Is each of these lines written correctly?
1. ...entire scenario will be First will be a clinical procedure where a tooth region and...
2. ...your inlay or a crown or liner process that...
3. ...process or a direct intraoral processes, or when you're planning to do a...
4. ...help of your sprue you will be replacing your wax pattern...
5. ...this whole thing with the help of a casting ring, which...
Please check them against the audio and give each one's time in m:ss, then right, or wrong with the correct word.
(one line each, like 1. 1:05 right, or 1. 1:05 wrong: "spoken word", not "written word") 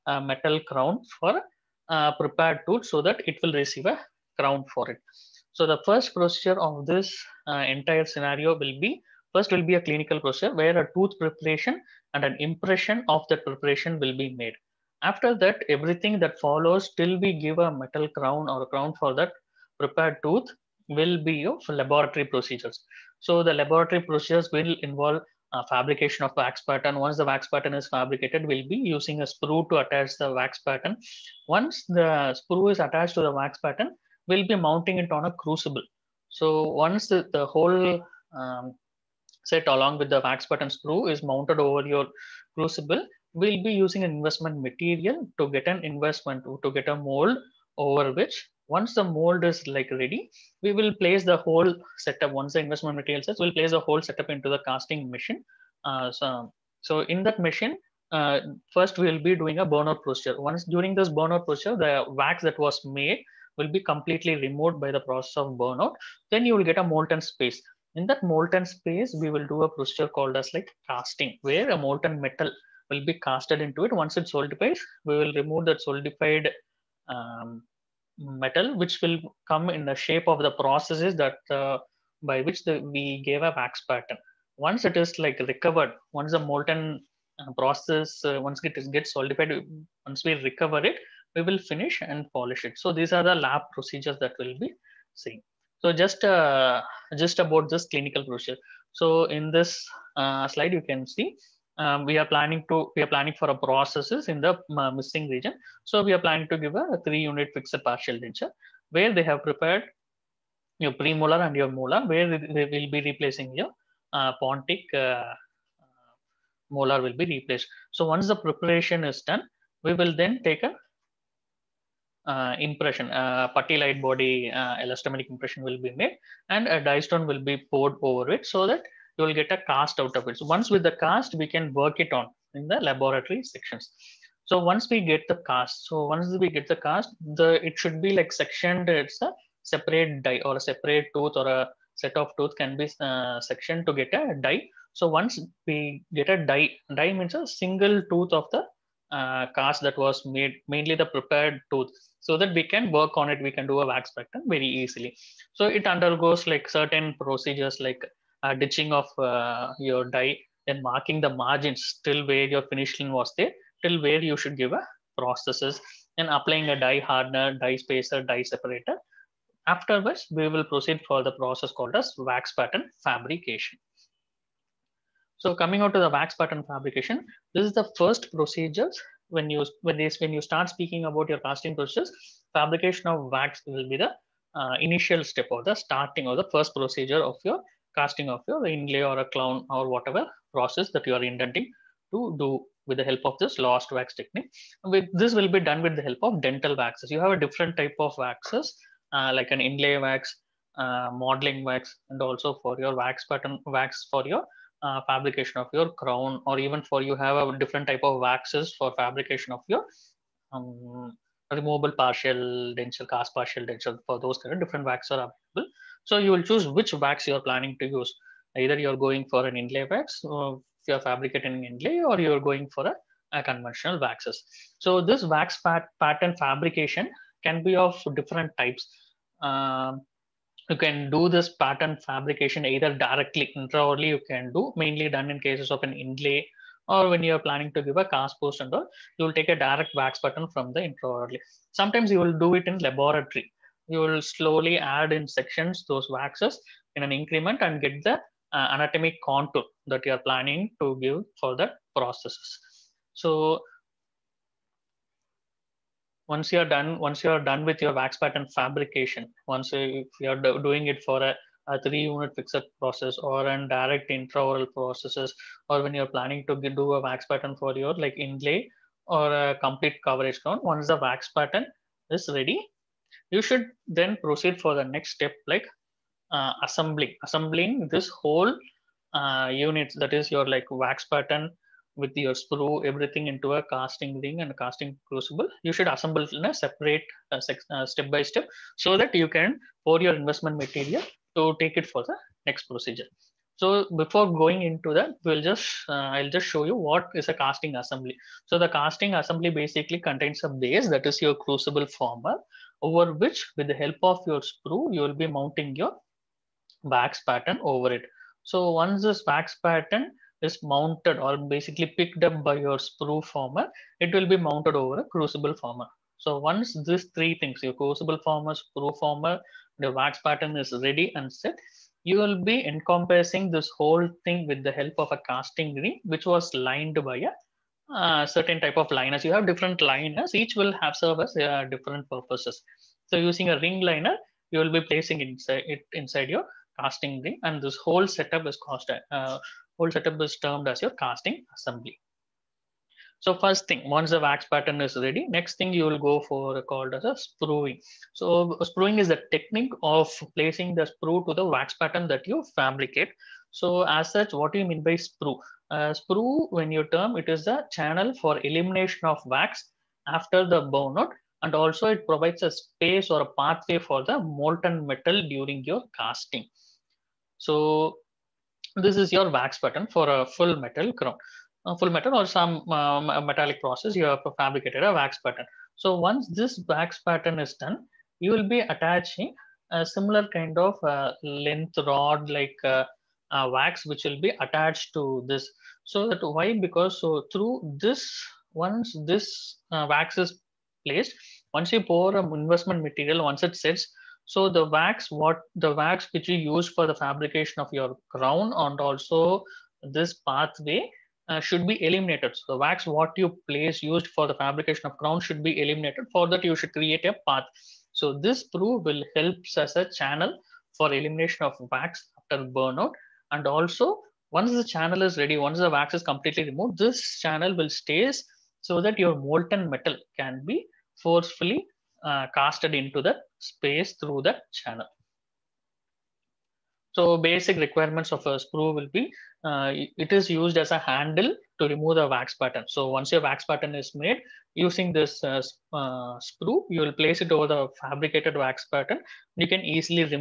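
1. 0:07 wrong: "preparation", not "region"
2. 3:08 wrong: "whatever", not "liner"
3. 4:22 right
4. 5:03 wrong: "mounting", not "replacing"
5. 5:23 right.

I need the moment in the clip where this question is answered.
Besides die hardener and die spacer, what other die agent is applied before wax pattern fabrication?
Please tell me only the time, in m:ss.
2:48.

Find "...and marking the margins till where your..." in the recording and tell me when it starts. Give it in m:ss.
2:40.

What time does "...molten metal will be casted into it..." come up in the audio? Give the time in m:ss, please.
1:11.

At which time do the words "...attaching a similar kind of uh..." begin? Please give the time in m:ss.
6:18.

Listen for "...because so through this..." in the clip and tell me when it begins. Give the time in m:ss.
6:26.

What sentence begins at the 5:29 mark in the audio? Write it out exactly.
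You have different liners, each will have service uh, different purposes.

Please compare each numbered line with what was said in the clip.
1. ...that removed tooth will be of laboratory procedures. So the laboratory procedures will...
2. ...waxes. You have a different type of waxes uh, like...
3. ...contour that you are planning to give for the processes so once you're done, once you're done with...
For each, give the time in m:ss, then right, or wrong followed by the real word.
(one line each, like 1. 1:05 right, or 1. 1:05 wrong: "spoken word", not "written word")
1. 0:19 wrong: "prepared", not "removed"
2. 3:16 right
3. 4:09 right.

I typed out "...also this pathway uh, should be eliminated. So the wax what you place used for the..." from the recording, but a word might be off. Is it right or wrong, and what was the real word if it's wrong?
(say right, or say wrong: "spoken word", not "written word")
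right.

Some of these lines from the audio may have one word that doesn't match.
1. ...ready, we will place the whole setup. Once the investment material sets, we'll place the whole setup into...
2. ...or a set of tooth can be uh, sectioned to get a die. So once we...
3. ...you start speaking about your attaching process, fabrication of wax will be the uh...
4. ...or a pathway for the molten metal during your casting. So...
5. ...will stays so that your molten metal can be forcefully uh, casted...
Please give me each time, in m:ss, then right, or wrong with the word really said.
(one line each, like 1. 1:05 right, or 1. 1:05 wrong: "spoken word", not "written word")
1. 0:49 right
2. 2:21 right
3. 3:00 wrong: "casting", not "attaching"
4. 6:03 right
5. 6:57 right.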